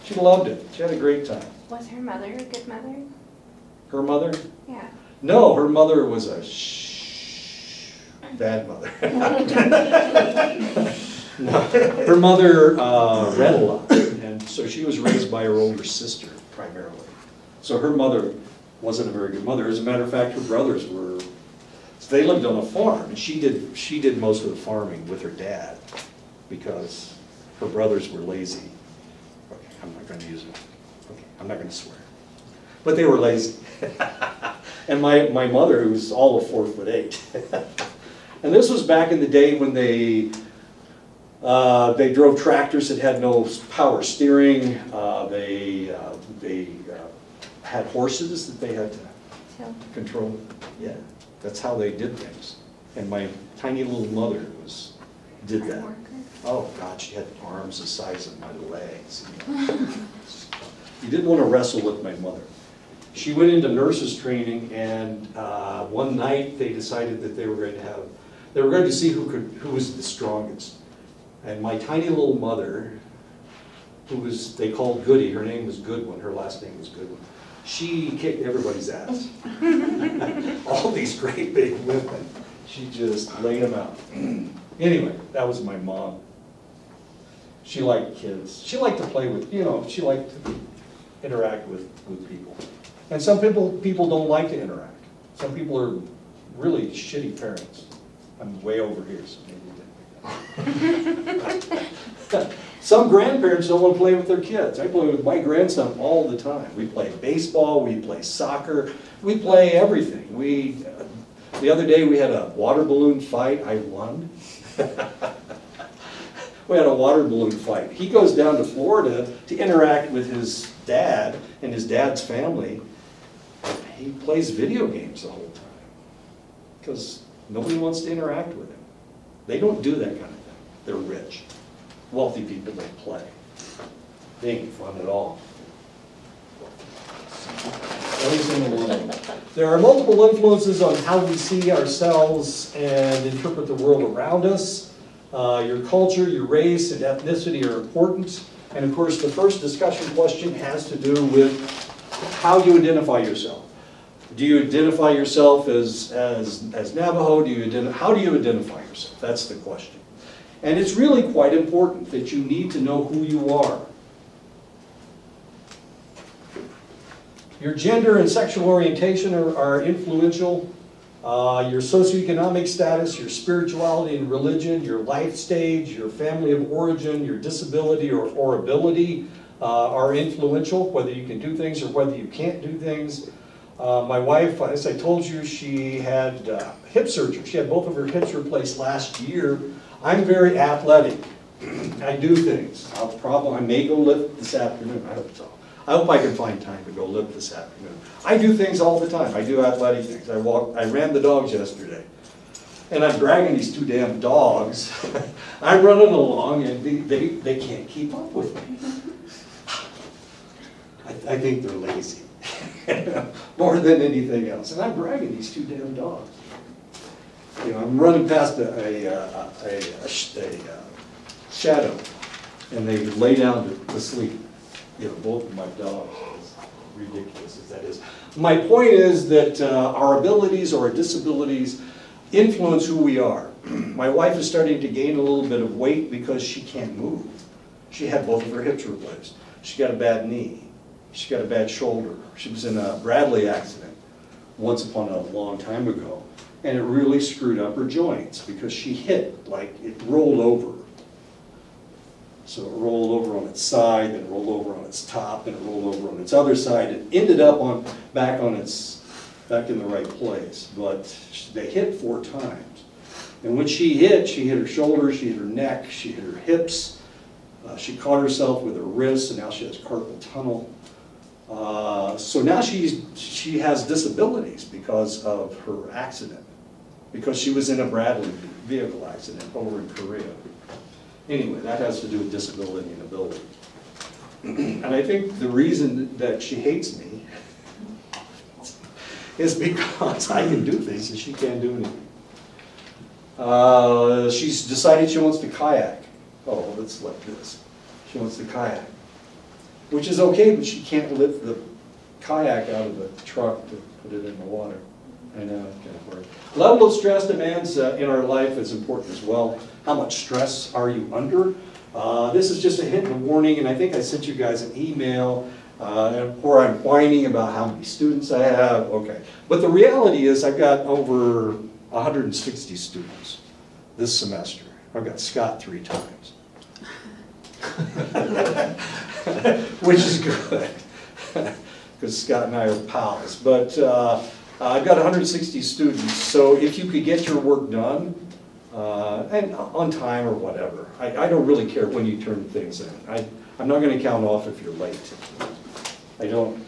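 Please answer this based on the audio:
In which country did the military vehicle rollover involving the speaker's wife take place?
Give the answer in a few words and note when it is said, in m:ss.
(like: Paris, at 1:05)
Korea, at 4:39.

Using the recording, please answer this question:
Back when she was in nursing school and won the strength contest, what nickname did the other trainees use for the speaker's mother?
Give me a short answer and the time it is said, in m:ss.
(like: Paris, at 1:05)
Goody, at 1:15.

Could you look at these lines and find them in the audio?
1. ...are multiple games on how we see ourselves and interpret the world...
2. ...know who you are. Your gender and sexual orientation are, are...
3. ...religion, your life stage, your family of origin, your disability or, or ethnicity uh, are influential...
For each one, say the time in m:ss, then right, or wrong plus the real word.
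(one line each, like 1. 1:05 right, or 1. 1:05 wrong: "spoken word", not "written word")
1. 2:19 wrong: "influences", not "games"
2. 2:42 right
3. 2:54 wrong: "ability", not "ethnicity".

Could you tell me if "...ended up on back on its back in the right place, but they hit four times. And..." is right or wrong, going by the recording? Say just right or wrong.
right.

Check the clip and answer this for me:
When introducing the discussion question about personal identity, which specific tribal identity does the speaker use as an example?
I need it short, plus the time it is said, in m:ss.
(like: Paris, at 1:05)
Navajo, at 2:36.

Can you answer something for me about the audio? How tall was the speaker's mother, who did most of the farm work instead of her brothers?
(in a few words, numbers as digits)
4 foot 8.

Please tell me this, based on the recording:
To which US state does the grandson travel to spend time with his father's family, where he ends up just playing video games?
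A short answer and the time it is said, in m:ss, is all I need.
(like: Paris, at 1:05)
Florida, at 1:58.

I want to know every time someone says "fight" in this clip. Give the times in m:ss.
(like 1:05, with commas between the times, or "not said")
1:53, 1:57.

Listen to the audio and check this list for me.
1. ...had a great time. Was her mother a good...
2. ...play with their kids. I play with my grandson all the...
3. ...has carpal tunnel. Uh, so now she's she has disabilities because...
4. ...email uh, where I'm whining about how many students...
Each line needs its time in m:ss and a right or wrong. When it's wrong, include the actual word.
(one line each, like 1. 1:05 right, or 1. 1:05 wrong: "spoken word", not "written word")
1. 0:00 right
2. 1:43 right
3. 4:29 right
4. 5:14 right.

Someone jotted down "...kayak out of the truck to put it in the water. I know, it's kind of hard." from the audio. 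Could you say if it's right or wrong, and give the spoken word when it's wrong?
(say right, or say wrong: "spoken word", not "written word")
right.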